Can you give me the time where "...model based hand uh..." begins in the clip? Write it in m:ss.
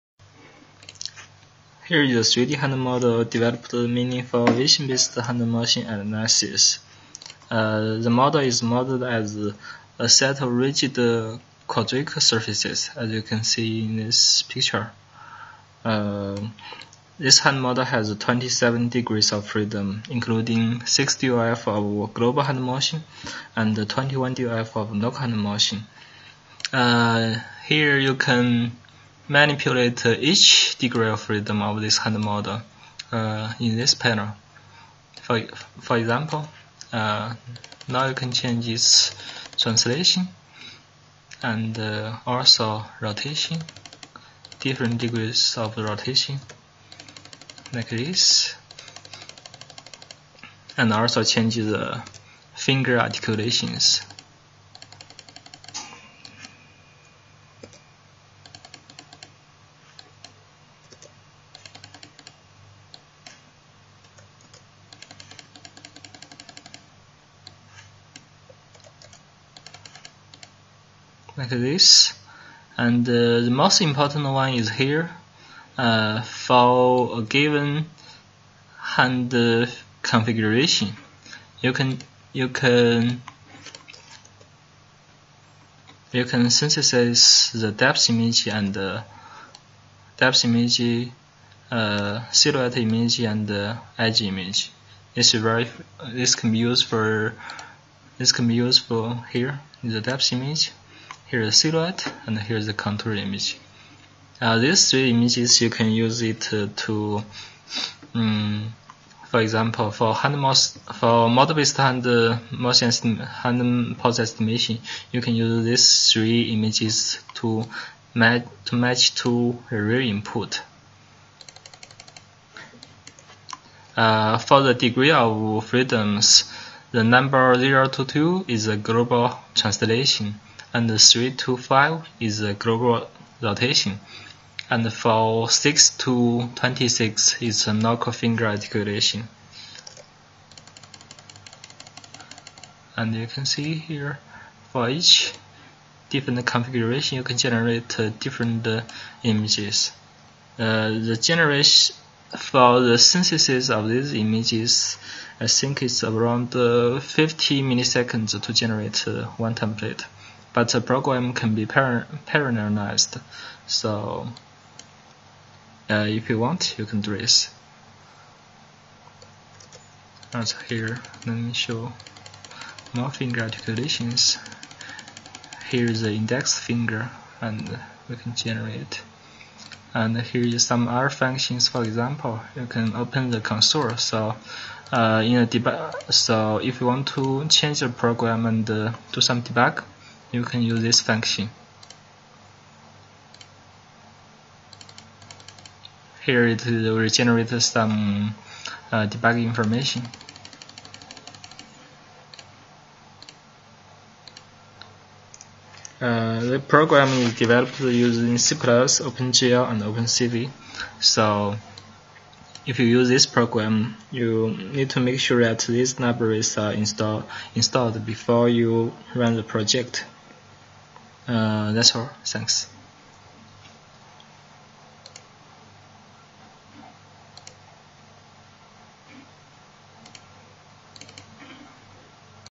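1:51.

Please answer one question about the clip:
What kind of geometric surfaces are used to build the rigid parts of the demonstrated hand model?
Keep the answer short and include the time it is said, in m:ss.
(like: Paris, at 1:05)
quadric surfaces, at 0:11.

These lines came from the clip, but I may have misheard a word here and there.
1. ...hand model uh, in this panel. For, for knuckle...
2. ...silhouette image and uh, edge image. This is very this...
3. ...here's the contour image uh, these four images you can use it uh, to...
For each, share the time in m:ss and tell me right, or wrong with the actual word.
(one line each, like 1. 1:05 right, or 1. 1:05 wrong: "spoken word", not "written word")
1. 0:31 wrong: "example", not "knuckle"
2. 1:32 right
3. 1:42 wrong: "three", not "four".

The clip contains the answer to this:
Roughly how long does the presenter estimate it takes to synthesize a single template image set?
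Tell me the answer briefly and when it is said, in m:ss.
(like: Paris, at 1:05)
50 milliseconds, at 2:36.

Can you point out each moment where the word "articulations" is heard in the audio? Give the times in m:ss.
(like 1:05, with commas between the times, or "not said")
0:52, 2:18, 2:53.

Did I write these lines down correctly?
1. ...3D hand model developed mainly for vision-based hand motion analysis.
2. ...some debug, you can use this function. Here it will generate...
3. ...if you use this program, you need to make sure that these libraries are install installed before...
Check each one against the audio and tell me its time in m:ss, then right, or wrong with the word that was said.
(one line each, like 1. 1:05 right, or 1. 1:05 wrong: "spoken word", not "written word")
1. 0:02 right
2. 3:09 right
3. 3:32 right.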